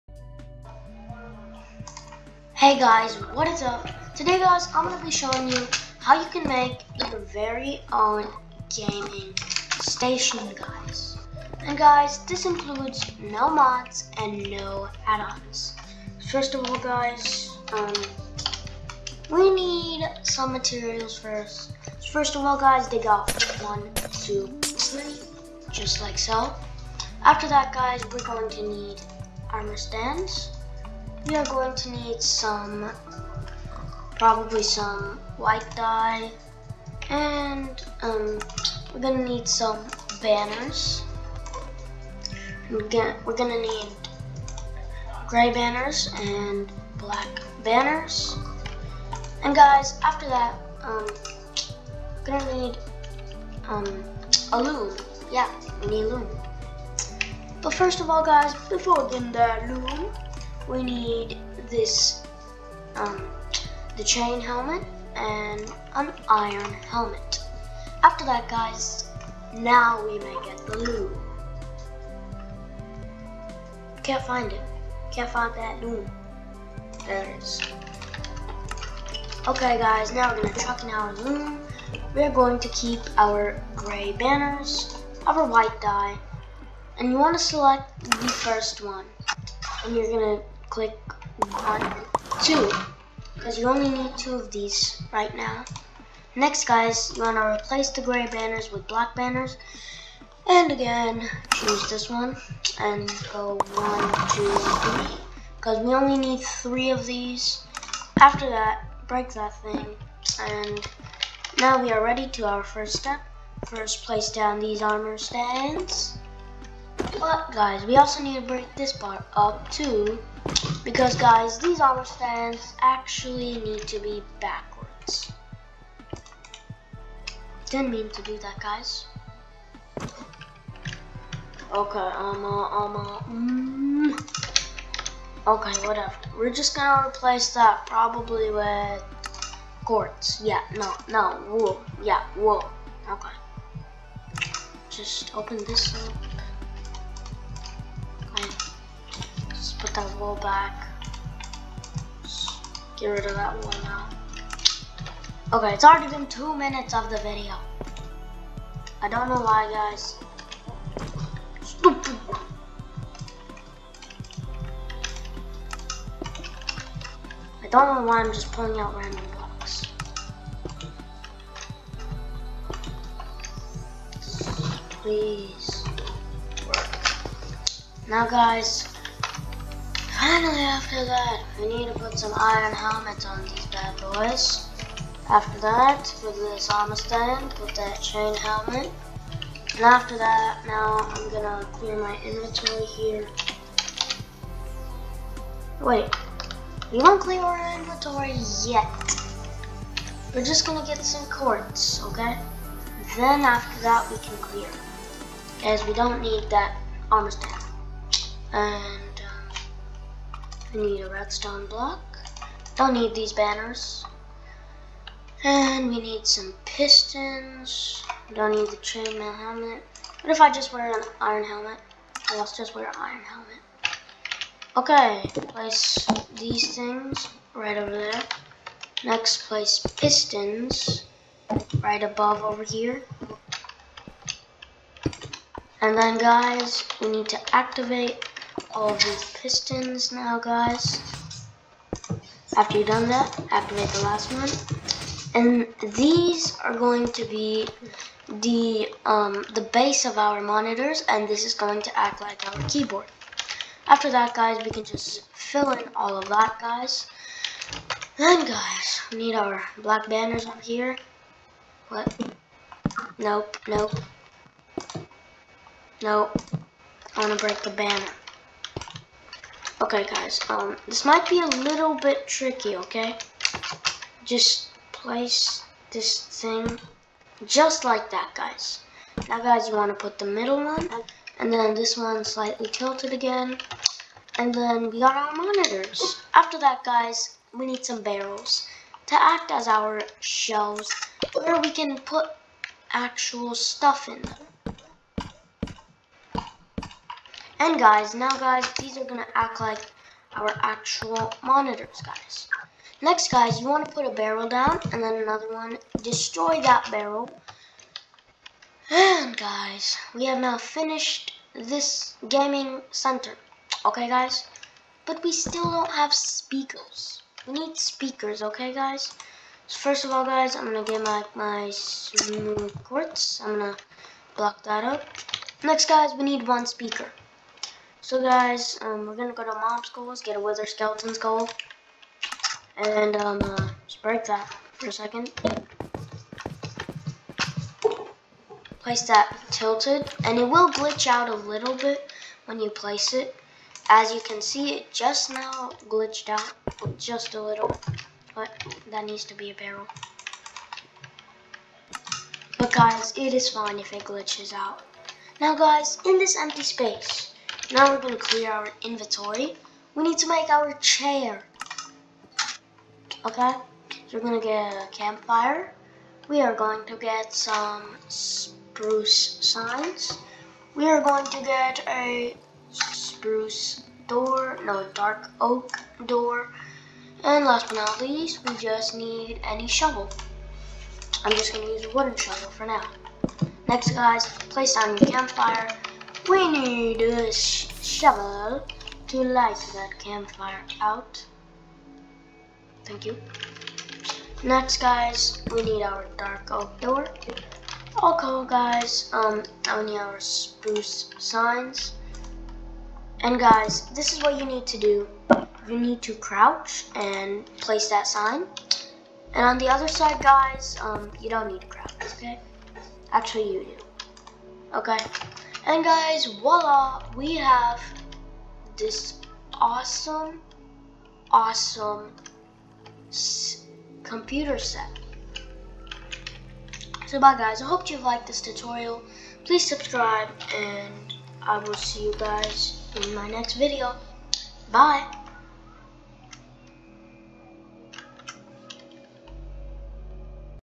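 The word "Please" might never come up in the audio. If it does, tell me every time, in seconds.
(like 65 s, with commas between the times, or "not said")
175 s, 429 s.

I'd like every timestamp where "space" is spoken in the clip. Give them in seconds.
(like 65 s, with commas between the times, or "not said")
356 s.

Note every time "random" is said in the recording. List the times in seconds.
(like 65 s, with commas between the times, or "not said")
168 s.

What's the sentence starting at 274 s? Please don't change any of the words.
Just place this thing just like that, guys.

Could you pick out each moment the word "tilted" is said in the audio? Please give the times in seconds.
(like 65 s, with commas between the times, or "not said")
282 s, 339 s.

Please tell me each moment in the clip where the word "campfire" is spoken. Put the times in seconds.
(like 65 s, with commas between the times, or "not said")
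364 s, 385 s, 389 s.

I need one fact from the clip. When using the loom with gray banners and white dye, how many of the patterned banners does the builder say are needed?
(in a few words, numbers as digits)
2.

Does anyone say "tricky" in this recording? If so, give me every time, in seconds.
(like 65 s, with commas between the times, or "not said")
272 s.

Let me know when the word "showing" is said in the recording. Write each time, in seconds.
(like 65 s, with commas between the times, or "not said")
5 s.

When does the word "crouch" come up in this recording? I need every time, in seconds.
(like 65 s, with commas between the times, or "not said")
406 s, 411 s.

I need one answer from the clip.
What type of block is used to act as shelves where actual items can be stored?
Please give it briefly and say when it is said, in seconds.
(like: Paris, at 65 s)
Barrels, at 287 s.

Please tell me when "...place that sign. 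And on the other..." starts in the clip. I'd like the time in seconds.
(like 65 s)
407 s.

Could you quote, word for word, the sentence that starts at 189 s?
And after that, now I'm gonna clear my inventory here.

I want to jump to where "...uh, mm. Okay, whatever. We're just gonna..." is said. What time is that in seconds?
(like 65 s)
132 s.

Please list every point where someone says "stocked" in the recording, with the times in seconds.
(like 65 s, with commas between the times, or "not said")
not said.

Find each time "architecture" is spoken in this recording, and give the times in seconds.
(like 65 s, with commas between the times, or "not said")
not said.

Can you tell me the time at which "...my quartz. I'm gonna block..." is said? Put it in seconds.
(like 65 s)
321 s.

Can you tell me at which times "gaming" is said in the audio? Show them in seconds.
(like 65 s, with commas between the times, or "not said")
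8 s, 312 s.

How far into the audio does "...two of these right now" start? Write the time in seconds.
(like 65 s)
94 s.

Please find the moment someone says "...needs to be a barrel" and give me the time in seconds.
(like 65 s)
349 s.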